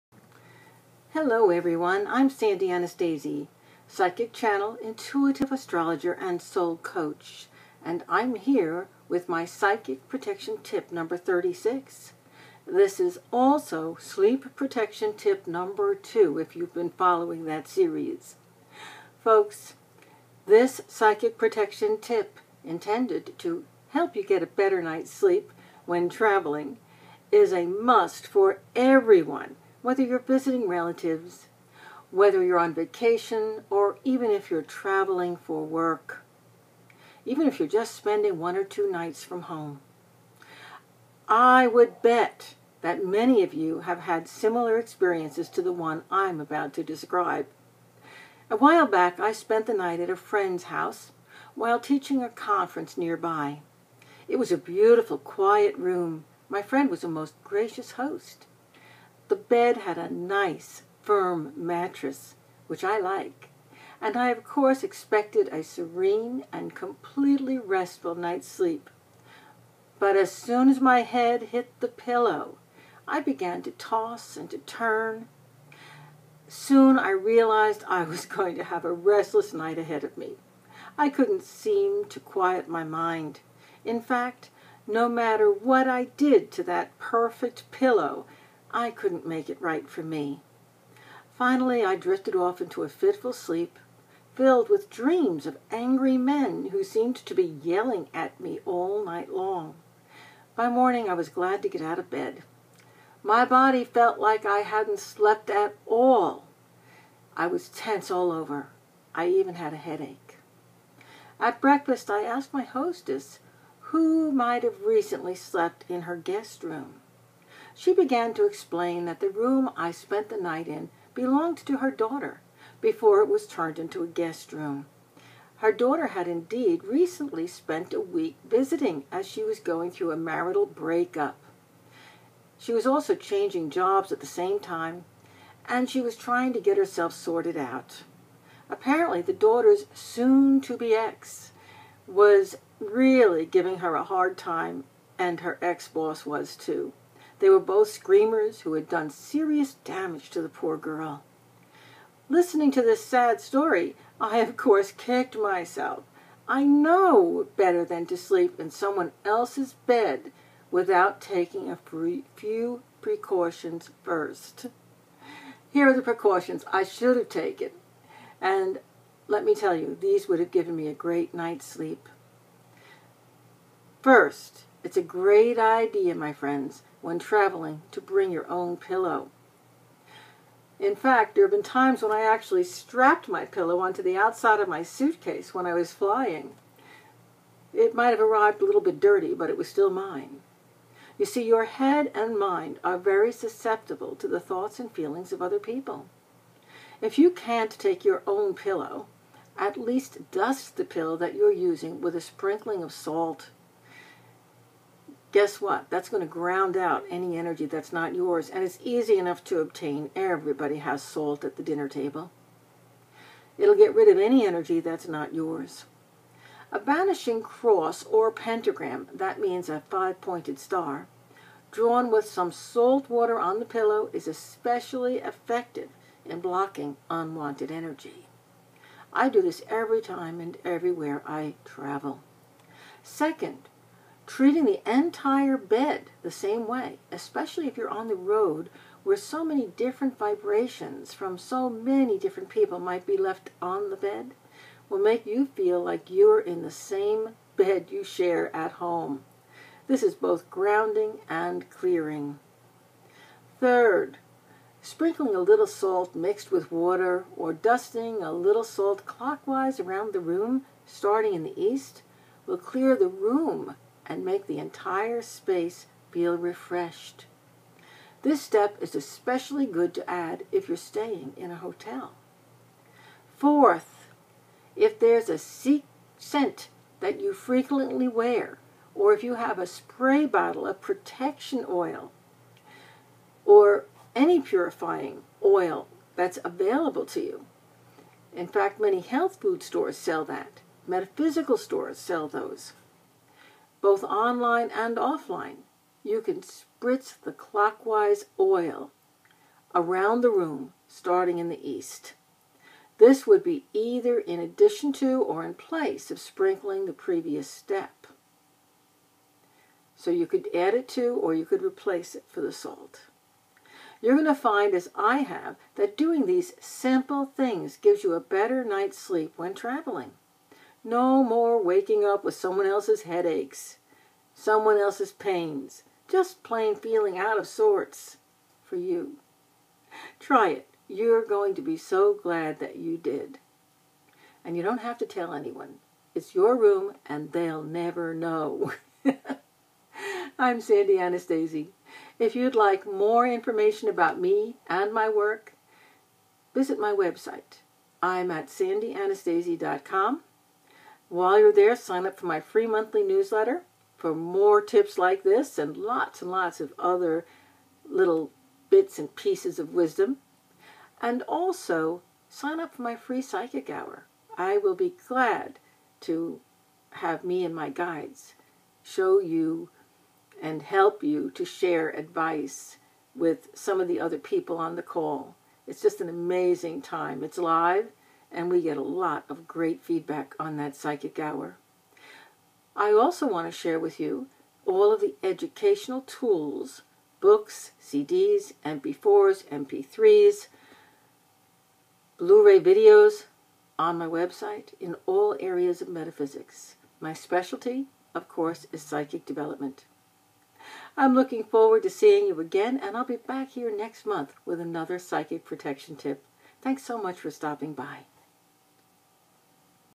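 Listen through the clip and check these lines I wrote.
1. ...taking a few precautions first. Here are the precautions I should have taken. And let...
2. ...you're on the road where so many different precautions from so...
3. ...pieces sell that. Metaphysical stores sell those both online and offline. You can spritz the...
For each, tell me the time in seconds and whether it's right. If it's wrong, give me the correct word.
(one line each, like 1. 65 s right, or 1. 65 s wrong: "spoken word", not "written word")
1. 161 s right
2. 237 s wrong: "vibrations", not "precautions"
3. 289 s wrong: "stores", not "pieces".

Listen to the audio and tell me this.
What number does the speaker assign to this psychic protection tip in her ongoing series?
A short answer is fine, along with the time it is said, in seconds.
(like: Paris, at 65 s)
36, at 11 s.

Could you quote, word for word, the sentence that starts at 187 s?
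It might have arrived a little bit dirty, but it was still mine.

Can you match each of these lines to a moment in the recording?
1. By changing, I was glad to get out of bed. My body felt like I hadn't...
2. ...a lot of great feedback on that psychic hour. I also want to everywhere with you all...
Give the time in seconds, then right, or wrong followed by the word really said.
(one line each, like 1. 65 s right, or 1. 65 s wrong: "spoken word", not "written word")
1. 100 s wrong: "morning", not "changing"
2. 378 s wrong: "share", not "everywhere".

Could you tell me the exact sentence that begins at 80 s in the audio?
I couldn't seem to quiet my mind.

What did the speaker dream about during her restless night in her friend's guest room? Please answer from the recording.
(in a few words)
angry men.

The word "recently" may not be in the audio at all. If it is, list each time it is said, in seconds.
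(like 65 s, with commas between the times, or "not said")
114 s, 126 s.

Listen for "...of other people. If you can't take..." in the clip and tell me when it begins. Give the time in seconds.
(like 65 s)
195 s.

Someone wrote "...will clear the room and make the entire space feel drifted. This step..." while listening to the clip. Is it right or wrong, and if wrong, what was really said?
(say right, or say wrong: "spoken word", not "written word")
wrong: "refreshed", not "drifted".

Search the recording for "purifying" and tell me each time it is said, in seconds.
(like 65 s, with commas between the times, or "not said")
284 s.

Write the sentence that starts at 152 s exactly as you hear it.
Listening to this sad story, I of course kicked myself.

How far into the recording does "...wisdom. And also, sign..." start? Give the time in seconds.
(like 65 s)
359 s.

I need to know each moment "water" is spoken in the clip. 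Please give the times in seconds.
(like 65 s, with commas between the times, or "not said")
223 s, 256 s.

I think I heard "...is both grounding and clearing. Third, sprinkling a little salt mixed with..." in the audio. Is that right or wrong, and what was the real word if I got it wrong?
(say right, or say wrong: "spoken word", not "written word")
right.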